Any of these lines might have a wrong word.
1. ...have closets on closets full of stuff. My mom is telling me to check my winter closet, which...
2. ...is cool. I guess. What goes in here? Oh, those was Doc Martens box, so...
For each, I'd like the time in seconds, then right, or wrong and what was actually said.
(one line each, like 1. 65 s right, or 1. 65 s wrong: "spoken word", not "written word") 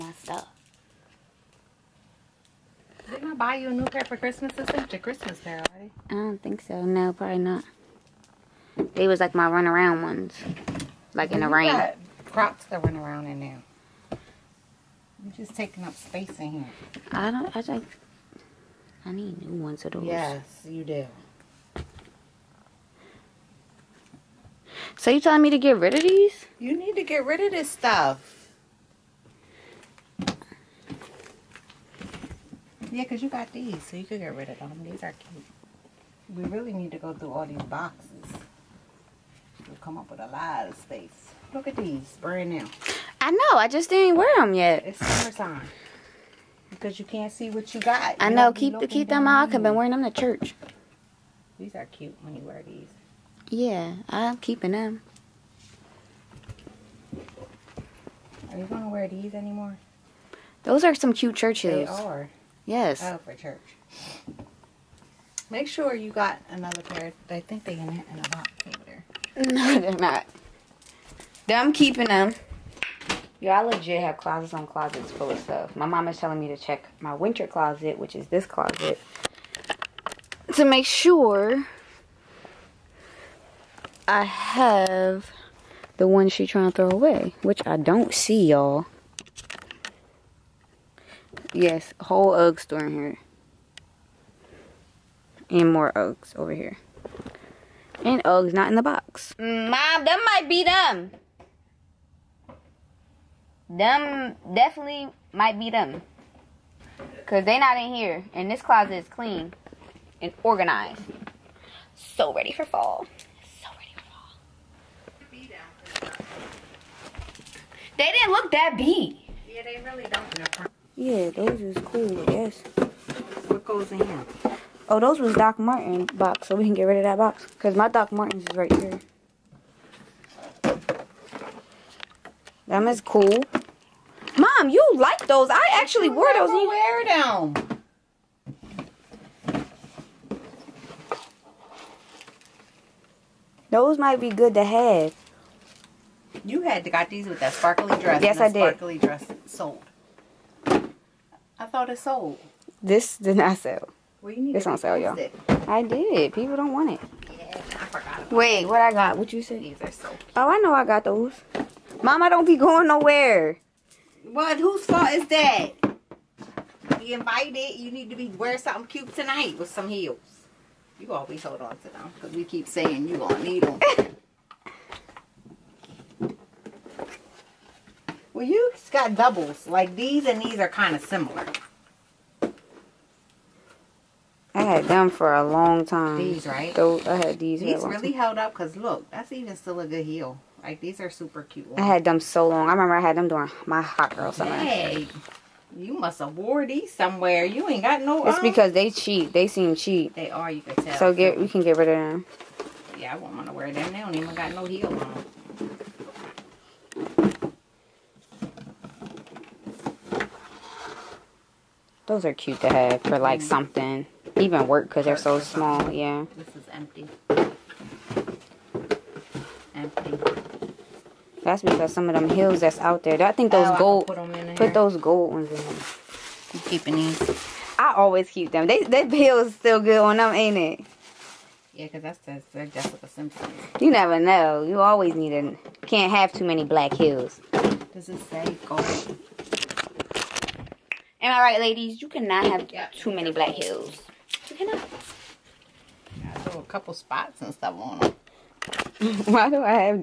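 1. 74 s right
2. 121 s right.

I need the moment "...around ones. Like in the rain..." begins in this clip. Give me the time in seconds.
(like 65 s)
9 s.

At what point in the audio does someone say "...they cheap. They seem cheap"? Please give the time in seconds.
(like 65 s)
198 s.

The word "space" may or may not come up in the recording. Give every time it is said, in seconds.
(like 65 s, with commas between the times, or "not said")
15 s, 40 s.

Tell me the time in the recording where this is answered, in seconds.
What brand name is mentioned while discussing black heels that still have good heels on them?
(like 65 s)
232 s.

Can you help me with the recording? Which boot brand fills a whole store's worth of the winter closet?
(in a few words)
Ugg.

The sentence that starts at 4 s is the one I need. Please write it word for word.
This ain't your Christmas pair already.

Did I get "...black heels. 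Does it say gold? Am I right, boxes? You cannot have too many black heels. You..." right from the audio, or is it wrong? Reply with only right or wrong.
wrong.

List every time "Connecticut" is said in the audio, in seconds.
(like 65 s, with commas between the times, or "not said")
not said.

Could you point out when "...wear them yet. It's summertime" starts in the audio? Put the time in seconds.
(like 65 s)
44 s.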